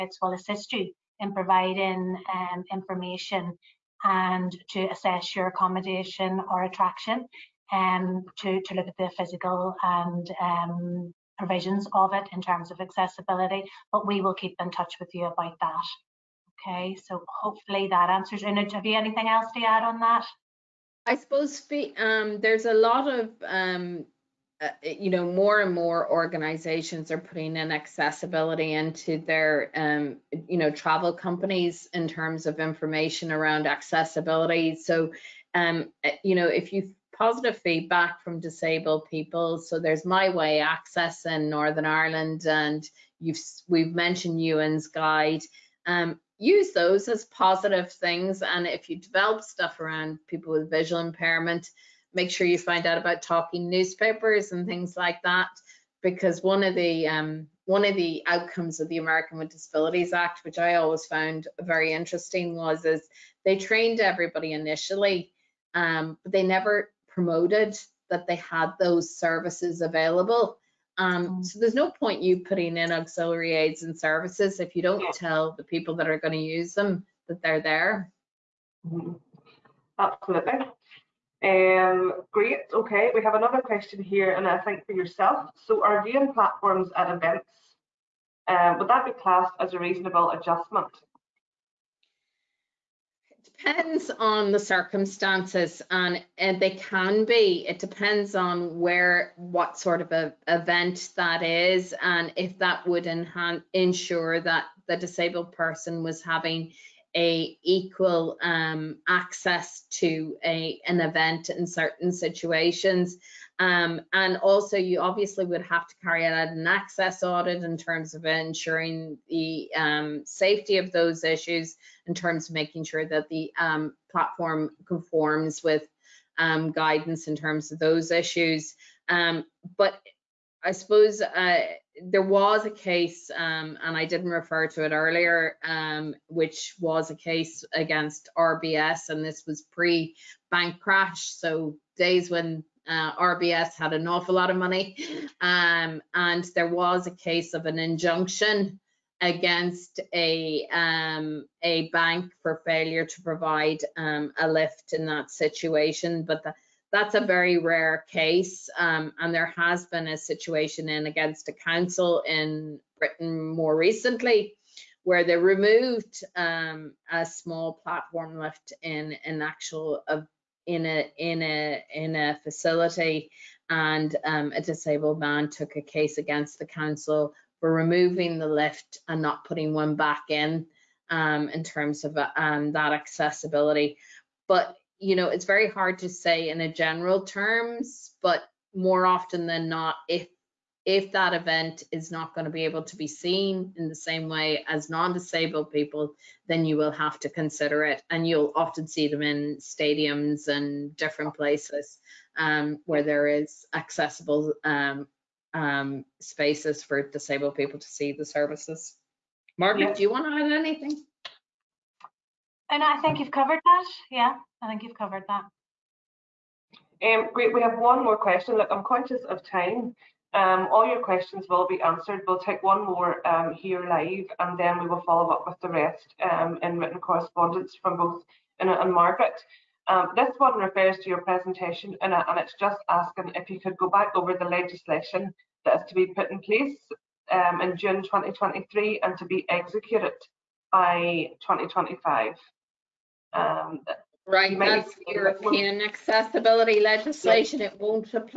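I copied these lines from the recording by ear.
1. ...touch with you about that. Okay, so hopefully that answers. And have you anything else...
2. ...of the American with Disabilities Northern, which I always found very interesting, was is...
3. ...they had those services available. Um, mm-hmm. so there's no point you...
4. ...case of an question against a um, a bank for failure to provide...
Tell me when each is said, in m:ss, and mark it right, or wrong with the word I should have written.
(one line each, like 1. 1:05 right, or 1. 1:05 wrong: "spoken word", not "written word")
1. 0:14 right
2. 0:58 wrong: "Act", not "Northern"
3. 1:08 right
4. 2:27 wrong: "injunction", not "question".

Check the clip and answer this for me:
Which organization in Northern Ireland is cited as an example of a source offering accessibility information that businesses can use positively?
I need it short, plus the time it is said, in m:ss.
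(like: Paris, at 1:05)
My Way Access, at 0:40.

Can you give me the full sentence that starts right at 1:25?
So, are viewing platforms at events um, would that be classed as a reasonable adjustment?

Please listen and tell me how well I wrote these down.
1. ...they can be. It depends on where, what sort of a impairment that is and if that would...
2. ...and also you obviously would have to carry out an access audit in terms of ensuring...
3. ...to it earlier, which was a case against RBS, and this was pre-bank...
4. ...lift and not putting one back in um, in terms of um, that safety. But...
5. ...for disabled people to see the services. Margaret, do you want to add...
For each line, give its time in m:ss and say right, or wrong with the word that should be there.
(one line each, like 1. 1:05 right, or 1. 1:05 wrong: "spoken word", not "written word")
1. 1:36 wrong: "event", not "impairment"
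2. 1:54 right
3. 2:14 right
4. 2:58 wrong: "accessibility", not "safety"
5. 3:26 right.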